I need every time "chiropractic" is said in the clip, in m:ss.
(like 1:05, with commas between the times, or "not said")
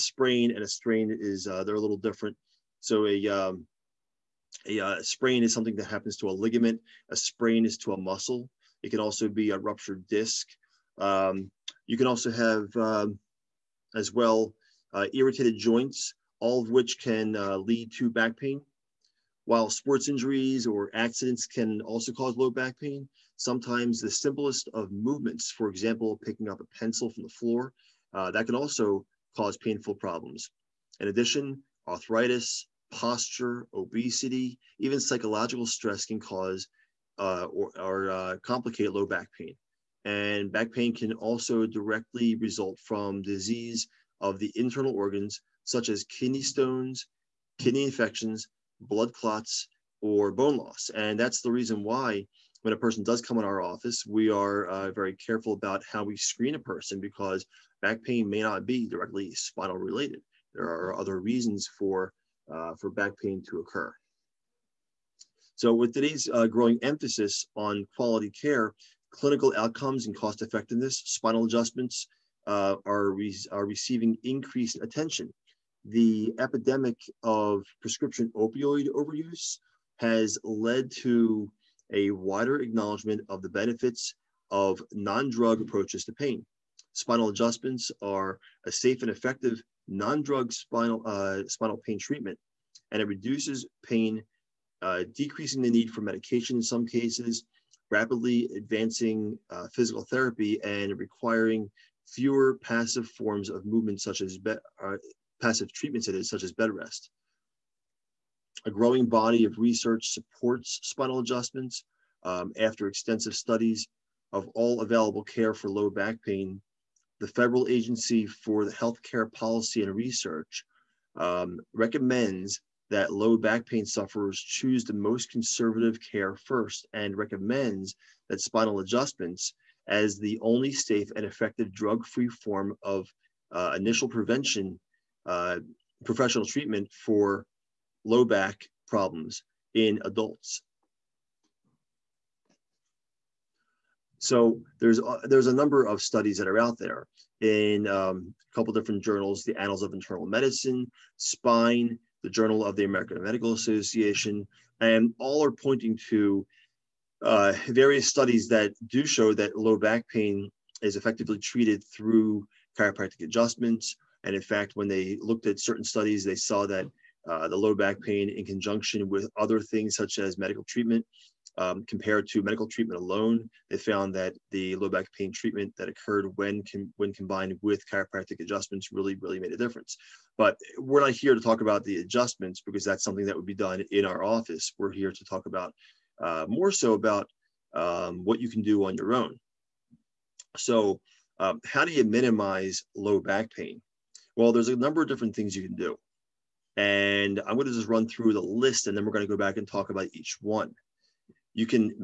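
2:42, 2:57.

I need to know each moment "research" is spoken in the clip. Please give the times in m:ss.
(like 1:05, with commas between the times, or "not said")
1:49, 1:59.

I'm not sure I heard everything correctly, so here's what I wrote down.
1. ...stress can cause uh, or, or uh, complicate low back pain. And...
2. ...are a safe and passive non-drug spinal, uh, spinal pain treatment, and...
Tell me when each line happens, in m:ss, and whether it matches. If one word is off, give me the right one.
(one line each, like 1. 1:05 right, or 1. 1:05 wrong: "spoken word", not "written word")
1. 0:35 right
2. 1:28 wrong: "effective", not "passive".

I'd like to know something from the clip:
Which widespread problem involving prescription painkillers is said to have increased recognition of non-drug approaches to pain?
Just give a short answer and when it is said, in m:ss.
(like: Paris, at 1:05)
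Opioid overuse, at 1:18.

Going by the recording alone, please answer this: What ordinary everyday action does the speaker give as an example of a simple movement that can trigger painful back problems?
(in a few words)
Picking up a pencil.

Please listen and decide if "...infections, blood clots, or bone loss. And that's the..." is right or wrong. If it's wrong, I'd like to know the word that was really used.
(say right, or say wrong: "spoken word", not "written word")
right.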